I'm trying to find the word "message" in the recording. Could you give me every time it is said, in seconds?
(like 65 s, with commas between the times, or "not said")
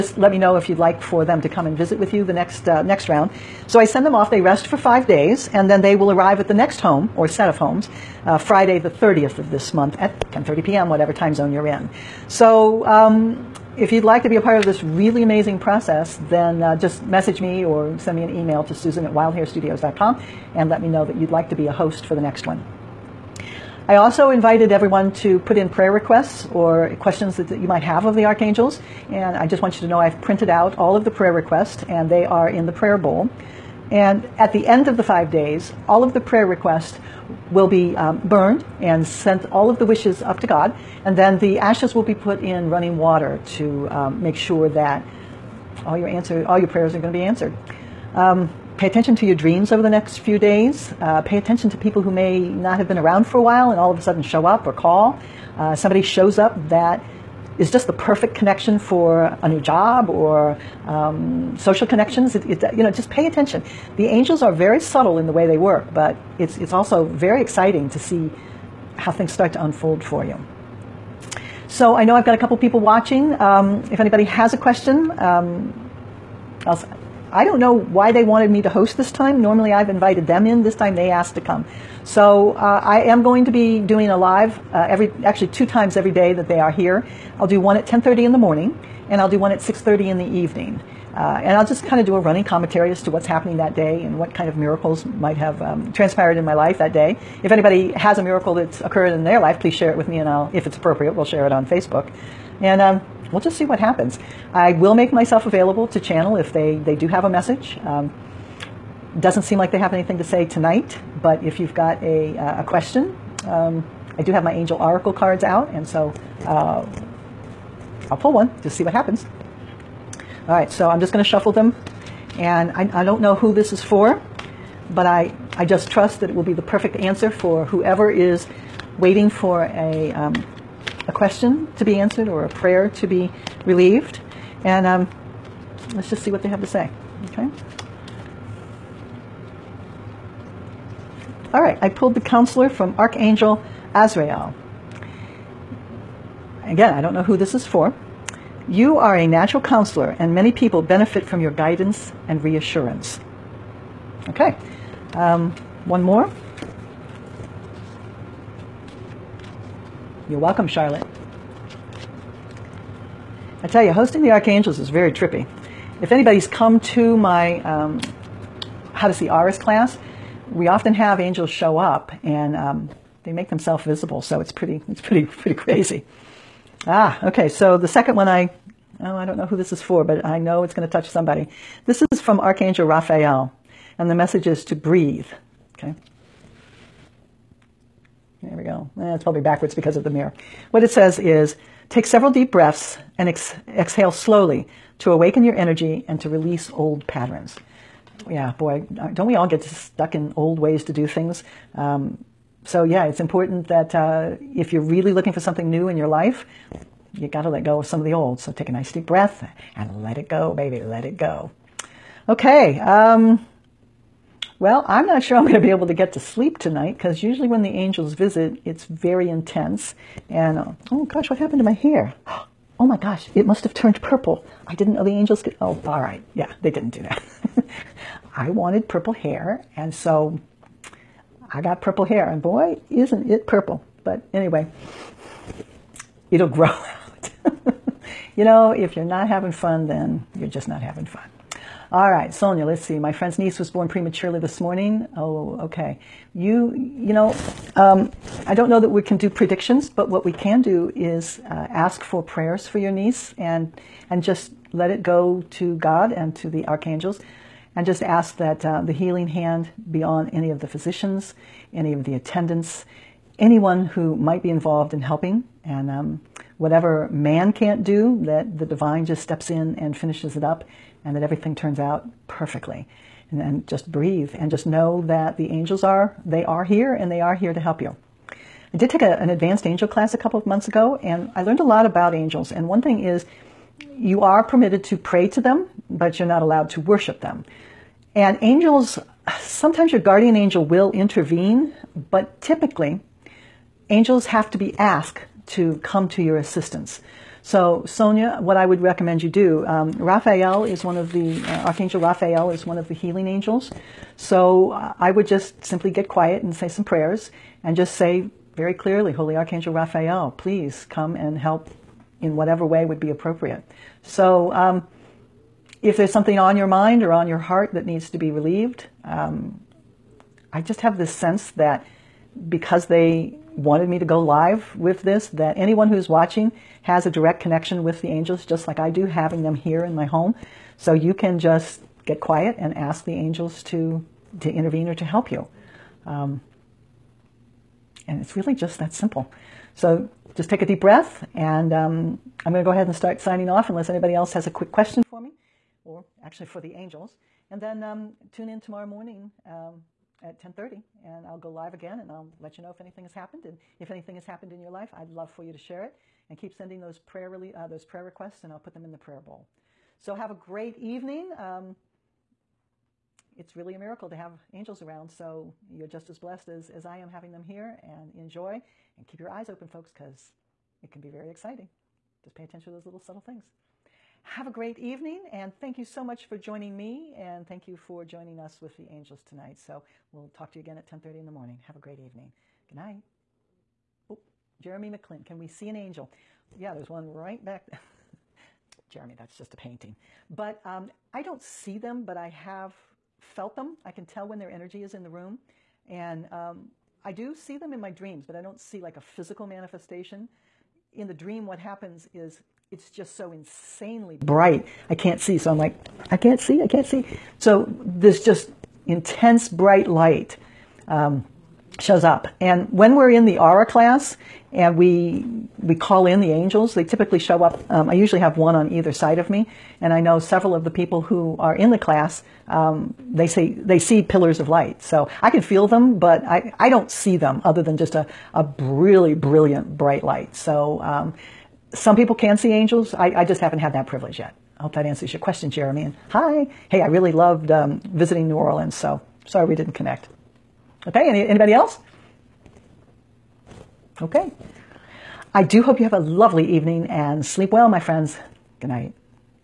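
17 s, 107 s, 184 s.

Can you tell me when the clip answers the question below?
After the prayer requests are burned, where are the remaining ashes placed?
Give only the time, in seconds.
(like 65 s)
42 s.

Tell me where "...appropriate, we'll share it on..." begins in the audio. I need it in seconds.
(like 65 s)
100 s.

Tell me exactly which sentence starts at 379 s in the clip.
So we'll talk to you again at 10:30 in the morning.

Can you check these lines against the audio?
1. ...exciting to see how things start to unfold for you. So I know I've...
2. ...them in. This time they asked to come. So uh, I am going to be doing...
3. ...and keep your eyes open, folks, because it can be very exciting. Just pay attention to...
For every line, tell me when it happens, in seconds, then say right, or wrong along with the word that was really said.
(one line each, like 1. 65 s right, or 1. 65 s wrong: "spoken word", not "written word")
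1. 67 s right
2. 80 s right
3. 368 s right.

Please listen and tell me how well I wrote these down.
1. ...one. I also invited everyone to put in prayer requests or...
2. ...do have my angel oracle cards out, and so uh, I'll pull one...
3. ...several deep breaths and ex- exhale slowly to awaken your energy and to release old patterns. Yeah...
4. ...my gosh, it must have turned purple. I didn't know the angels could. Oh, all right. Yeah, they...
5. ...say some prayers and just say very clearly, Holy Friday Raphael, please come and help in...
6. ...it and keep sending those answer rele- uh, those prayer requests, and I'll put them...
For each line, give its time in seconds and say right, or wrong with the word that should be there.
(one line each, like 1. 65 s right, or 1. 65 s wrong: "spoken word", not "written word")
1. 22 s right
2. 114 s right
3. 192 s right
4. 222 s right
5. 306 s wrong: "Archangel", not "Friday"
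6. 355 s wrong: "prayer", not "answer".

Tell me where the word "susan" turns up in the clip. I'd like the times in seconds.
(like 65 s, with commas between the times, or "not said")
18 s.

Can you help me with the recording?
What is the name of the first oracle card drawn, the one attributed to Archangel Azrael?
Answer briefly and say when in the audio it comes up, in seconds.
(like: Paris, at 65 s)
The counselor, at 142 s.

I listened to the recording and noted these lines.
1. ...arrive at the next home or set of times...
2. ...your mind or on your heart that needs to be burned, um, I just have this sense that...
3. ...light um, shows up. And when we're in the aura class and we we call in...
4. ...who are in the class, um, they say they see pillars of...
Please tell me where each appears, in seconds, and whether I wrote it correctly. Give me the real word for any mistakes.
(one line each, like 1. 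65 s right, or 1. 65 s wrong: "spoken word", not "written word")
1. 6 s wrong: "homes", not "times"
2. 316 s wrong: "relieved", not "burned"
3. 409 s right
4. 421 s right.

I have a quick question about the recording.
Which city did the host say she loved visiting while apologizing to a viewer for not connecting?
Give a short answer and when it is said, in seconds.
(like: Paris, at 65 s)
New Orleans, at 438 s.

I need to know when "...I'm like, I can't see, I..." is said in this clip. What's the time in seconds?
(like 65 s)
405 s.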